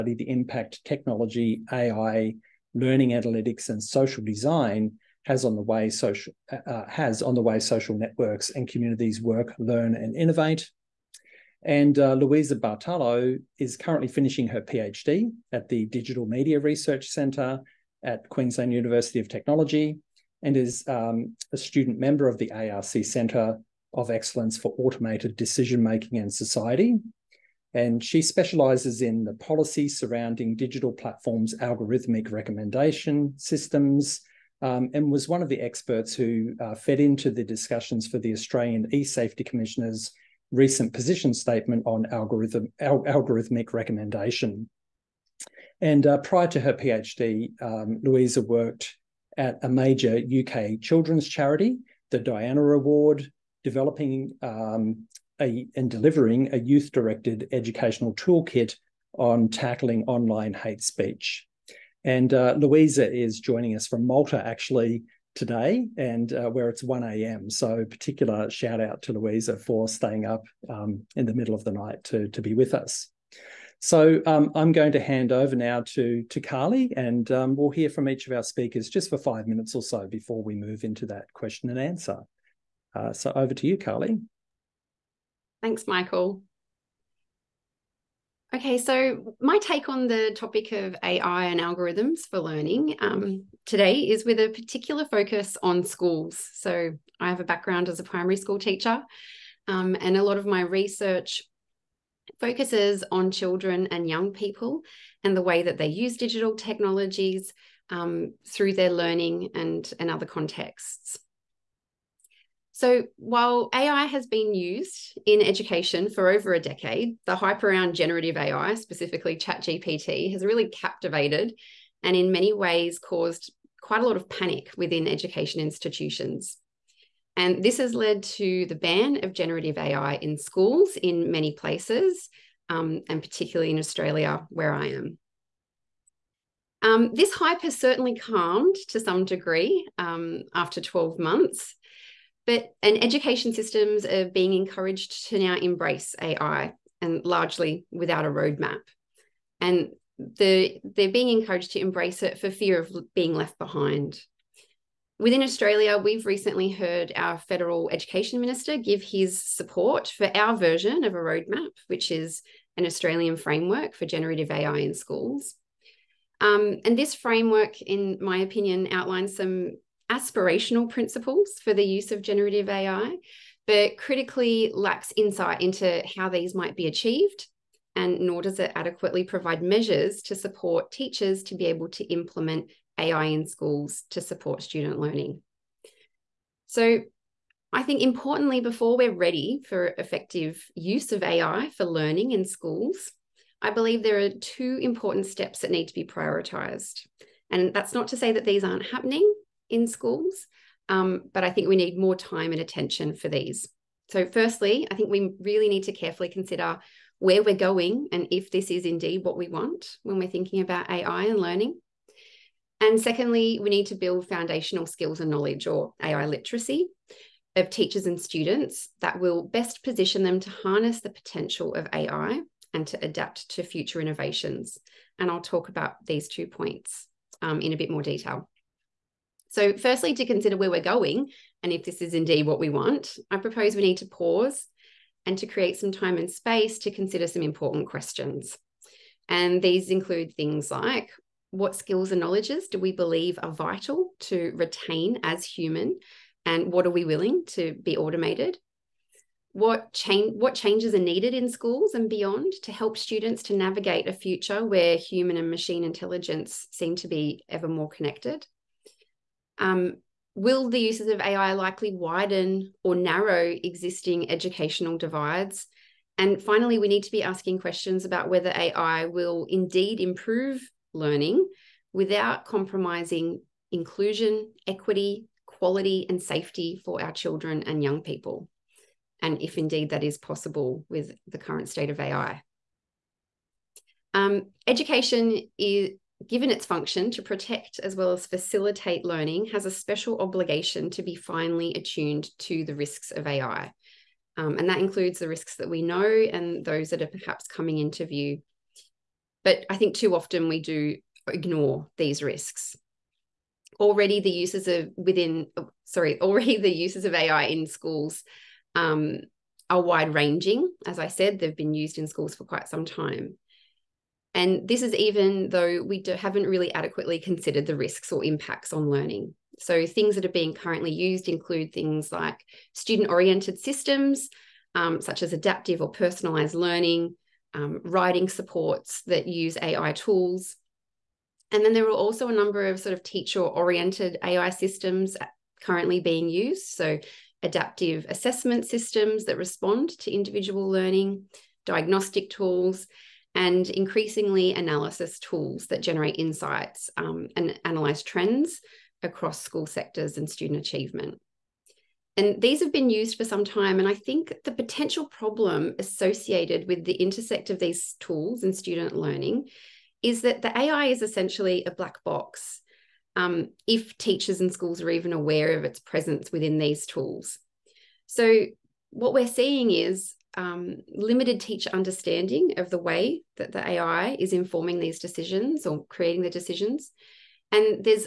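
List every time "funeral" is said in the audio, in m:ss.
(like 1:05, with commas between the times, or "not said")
not said.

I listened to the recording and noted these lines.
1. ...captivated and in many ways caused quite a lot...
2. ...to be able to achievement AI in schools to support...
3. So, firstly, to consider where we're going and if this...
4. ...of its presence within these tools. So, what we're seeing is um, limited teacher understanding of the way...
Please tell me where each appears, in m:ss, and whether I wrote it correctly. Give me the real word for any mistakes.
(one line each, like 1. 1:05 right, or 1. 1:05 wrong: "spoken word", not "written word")
1. 2:00 right
2. 3:01 wrong: "implement", not "achievement"
3. 3:49 right
4. 6:05 right.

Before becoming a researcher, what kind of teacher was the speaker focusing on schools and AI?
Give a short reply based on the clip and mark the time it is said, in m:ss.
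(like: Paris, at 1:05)
primary school teacher, at 1:38.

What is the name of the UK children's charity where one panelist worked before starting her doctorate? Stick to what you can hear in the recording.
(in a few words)
the Diana Award.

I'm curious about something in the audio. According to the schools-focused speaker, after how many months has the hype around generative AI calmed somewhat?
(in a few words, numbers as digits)
12 months.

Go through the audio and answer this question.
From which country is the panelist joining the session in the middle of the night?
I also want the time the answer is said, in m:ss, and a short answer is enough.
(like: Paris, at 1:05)
Malta, at 1:04.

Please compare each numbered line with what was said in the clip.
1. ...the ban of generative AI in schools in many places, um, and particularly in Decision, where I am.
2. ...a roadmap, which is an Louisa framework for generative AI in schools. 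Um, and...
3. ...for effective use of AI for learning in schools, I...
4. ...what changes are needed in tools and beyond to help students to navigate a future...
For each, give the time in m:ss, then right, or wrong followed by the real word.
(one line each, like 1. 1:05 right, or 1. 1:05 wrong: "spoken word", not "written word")
1. 2:08 wrong: "Australia", not "Decision"
2. 2:41 wrong: "Australian", not "Louisa"
3. 3:09 right
4. 4:10 wrong: "schools", not "tools".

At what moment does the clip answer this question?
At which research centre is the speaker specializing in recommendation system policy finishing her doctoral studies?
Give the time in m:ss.
0:15.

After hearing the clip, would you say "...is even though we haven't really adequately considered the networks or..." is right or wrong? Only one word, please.
wrong.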